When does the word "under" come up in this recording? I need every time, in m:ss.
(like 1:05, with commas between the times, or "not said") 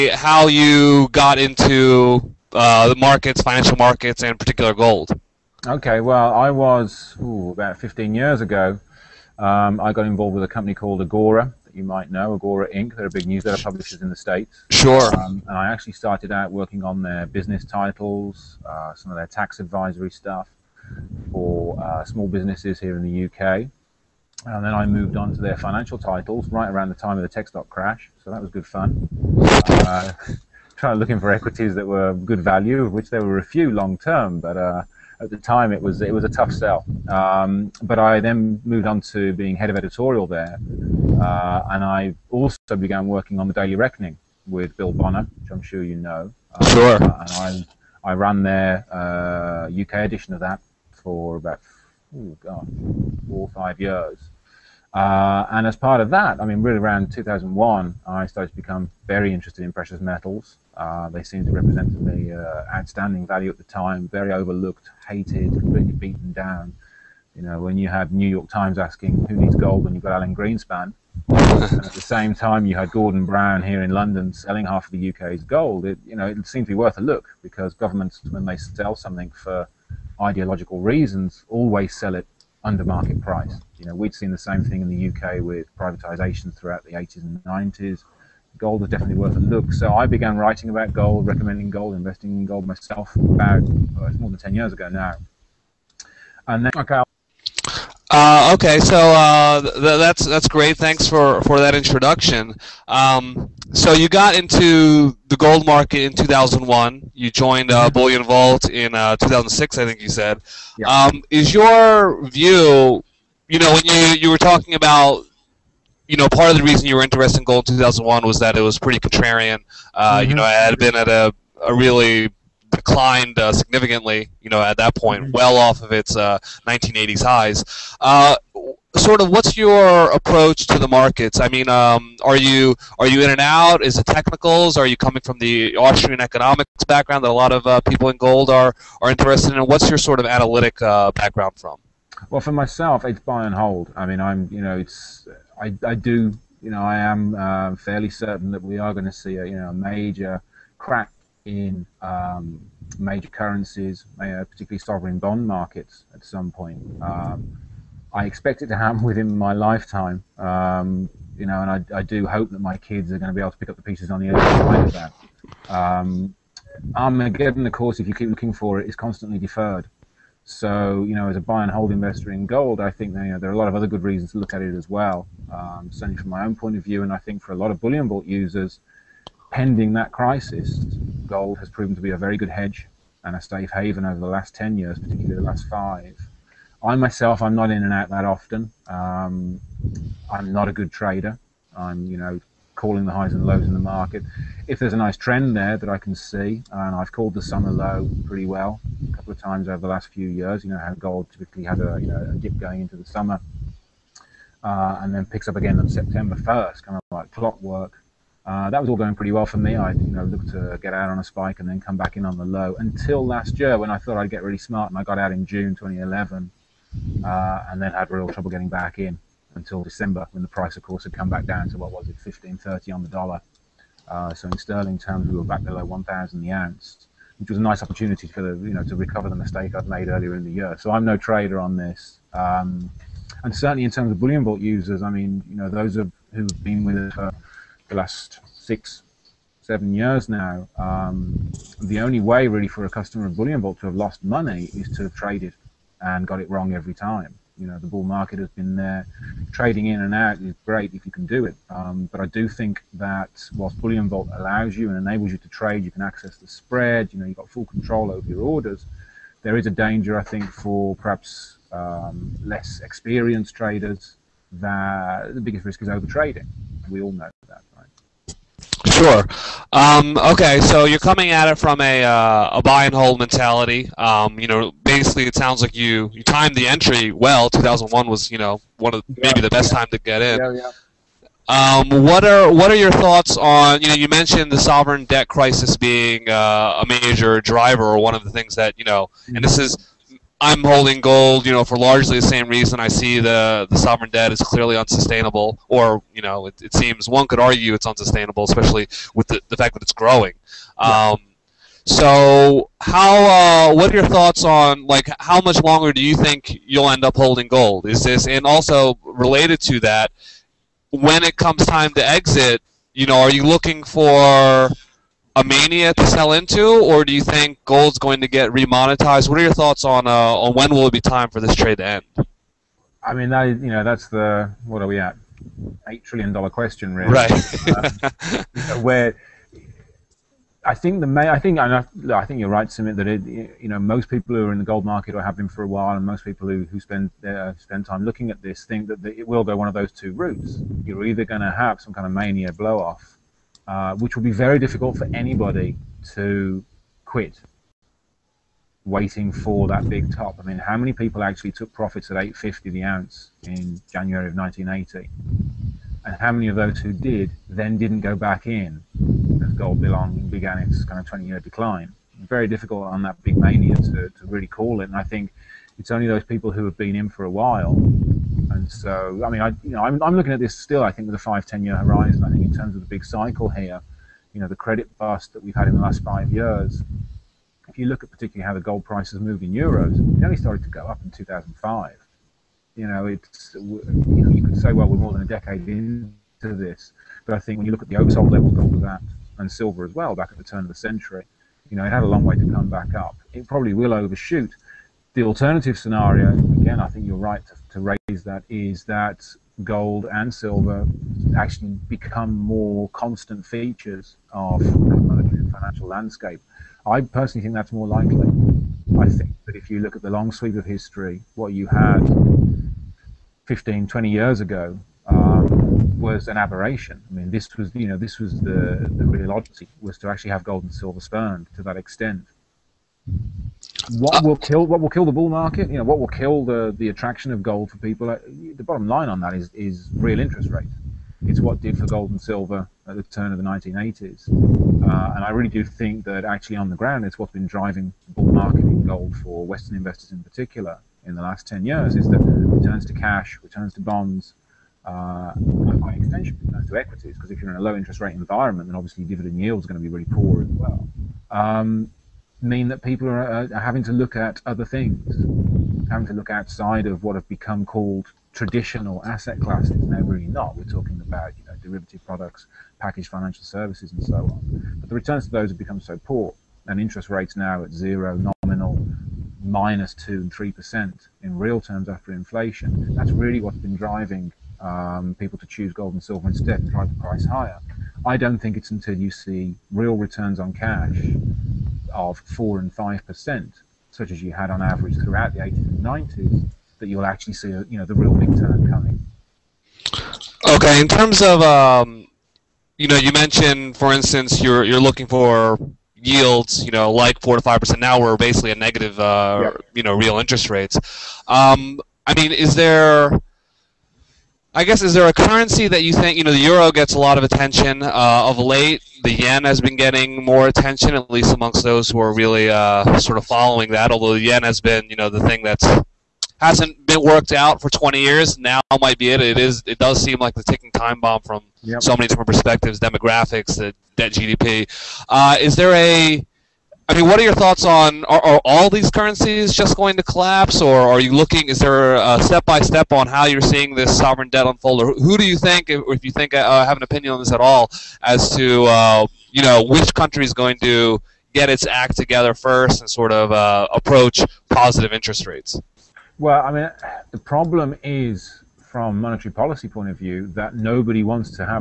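1:22.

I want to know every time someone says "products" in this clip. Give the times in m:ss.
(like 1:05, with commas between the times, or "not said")
7:42.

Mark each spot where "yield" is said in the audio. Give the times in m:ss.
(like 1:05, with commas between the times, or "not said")
7:29, 8:15.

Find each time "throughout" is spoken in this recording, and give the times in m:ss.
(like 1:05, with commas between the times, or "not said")
1:26, 8:04.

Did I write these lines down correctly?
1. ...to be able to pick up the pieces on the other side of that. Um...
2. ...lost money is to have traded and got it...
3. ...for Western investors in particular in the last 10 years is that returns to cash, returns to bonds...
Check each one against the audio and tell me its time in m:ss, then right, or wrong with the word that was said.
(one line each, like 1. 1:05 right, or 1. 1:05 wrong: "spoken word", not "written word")
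1. 2:43 right
2. 4:03 right
3. 7:19 right.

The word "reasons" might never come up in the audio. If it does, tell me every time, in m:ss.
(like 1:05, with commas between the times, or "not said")
1:20, 1:56, 2:54, 4:52.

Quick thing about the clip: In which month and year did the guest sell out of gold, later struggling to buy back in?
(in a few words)
June 2011.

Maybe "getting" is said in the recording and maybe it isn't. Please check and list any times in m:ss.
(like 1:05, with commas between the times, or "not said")
3:38, 8:29.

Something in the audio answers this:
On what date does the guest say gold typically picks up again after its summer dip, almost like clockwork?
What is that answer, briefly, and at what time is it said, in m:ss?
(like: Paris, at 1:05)
September 1st, at 3:25.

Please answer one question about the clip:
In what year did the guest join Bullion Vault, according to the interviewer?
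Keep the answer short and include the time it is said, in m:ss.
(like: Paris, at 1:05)
2006, at 1:49.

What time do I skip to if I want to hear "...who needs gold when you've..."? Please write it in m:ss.
1:09.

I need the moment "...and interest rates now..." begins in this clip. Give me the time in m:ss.
7:46.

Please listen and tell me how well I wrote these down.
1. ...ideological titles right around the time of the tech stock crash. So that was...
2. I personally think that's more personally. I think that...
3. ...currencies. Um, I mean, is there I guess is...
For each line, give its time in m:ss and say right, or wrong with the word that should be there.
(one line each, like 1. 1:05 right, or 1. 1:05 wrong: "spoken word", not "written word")
1. 0:25 wrong: "financial", not "ideological"
2. 6:46 wrong: "likely", not "personally"
3. 8:20 wrong: "rates", not "currencies".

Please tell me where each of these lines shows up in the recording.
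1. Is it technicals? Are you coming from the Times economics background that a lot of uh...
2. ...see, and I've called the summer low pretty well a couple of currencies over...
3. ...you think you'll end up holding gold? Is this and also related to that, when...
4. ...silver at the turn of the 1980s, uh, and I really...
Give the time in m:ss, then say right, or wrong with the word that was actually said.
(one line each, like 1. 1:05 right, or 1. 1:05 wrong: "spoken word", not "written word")
1. 2:13 wrong: "Austrian", not "Times"
2. 3:16 wrong: "times", not "currencies"
3. 5:06 right
4. 7:12 right.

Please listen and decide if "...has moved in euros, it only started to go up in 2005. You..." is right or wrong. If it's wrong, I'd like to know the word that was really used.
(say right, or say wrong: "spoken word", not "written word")
right.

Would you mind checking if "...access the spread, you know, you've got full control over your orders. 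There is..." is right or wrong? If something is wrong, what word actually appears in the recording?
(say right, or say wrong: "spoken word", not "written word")
right.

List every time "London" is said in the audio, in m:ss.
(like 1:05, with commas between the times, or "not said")
1:13.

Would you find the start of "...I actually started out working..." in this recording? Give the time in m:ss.
0:15.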